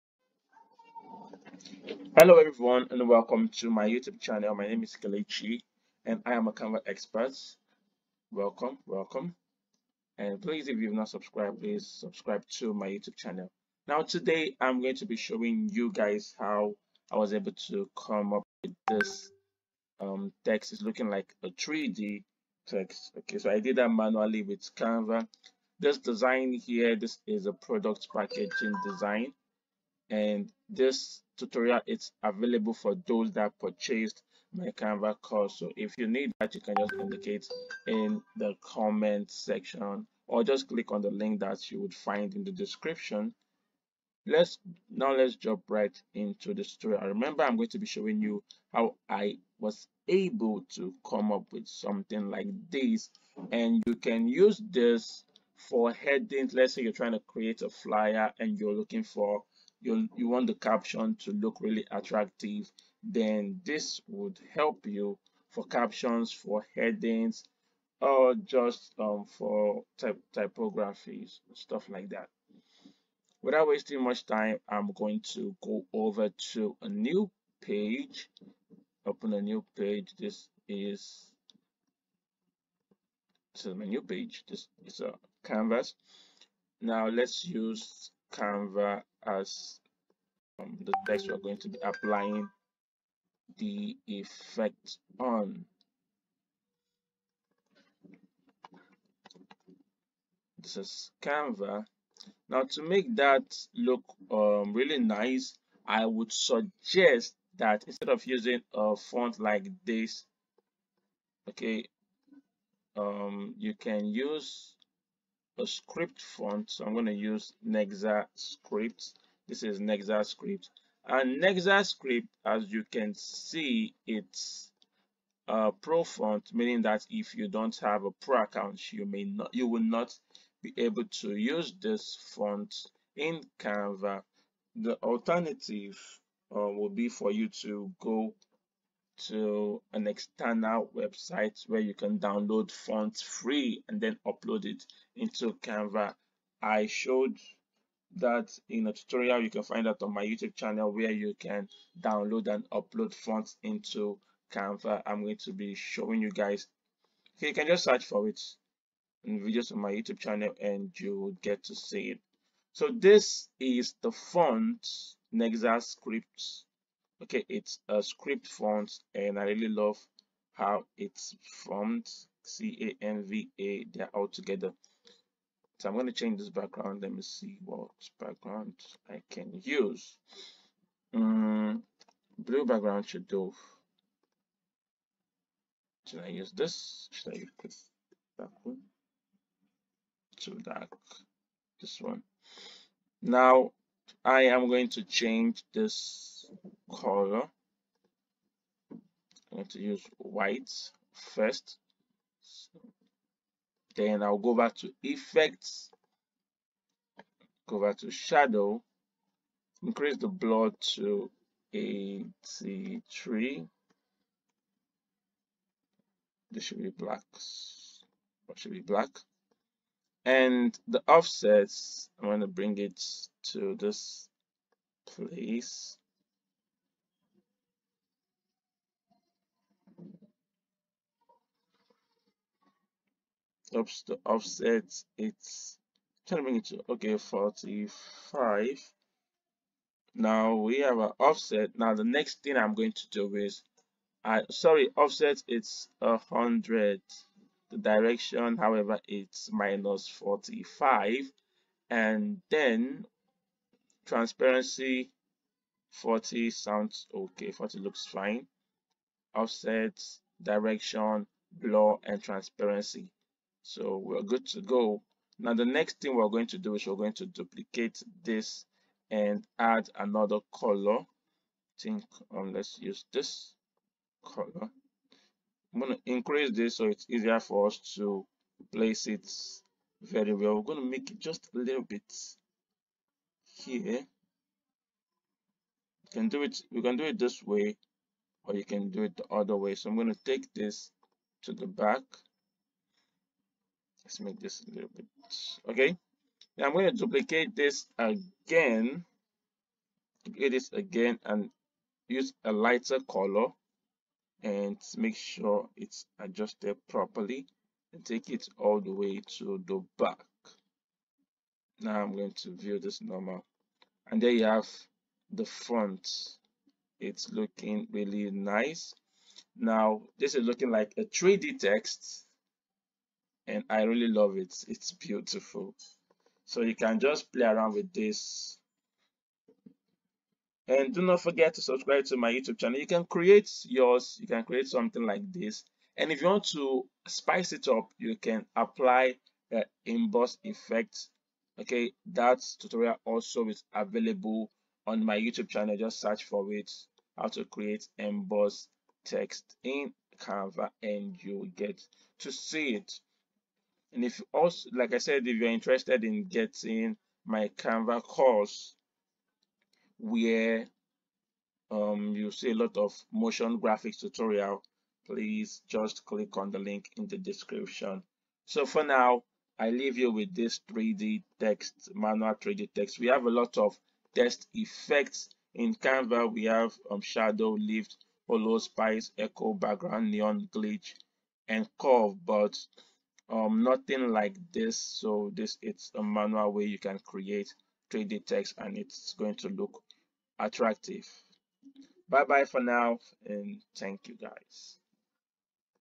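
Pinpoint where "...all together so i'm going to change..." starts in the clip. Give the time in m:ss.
2:54.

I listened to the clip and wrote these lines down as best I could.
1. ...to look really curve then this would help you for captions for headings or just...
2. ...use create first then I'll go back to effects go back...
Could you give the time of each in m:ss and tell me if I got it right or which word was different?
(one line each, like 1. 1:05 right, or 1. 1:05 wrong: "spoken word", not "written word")
1. 1:01 wrong: "attractive", not "curve"
2. 3:19 wrong: "white", not "create".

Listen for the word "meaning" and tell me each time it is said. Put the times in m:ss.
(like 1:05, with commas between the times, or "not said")
2:06.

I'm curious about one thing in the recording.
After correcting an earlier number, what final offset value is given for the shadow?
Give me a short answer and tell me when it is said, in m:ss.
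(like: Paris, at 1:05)
100, at 4:06.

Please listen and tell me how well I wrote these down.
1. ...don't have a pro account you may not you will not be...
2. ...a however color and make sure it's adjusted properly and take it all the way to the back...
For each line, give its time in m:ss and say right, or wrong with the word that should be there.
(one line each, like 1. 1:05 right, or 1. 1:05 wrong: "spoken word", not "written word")
1. 2:07 right
2. 5:02 wrong: "lighter", not "however".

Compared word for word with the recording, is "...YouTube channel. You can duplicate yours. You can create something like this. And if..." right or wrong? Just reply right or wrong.
wrong.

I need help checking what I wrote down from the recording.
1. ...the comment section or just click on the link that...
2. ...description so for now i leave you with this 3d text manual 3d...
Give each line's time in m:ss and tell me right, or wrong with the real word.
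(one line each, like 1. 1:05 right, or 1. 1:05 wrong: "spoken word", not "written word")
1. 0:38 right
2. 6:07 right.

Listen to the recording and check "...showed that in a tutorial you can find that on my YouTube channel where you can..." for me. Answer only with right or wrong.
right.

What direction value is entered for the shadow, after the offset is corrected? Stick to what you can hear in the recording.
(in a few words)
-45.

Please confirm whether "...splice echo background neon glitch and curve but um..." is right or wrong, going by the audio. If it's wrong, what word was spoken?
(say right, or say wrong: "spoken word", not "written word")
right.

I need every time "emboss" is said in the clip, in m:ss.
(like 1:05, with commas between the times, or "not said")
5:39, 5:47.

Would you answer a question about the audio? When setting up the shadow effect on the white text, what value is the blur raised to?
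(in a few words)
83.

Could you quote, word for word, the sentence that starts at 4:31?
Think um, let's use this color.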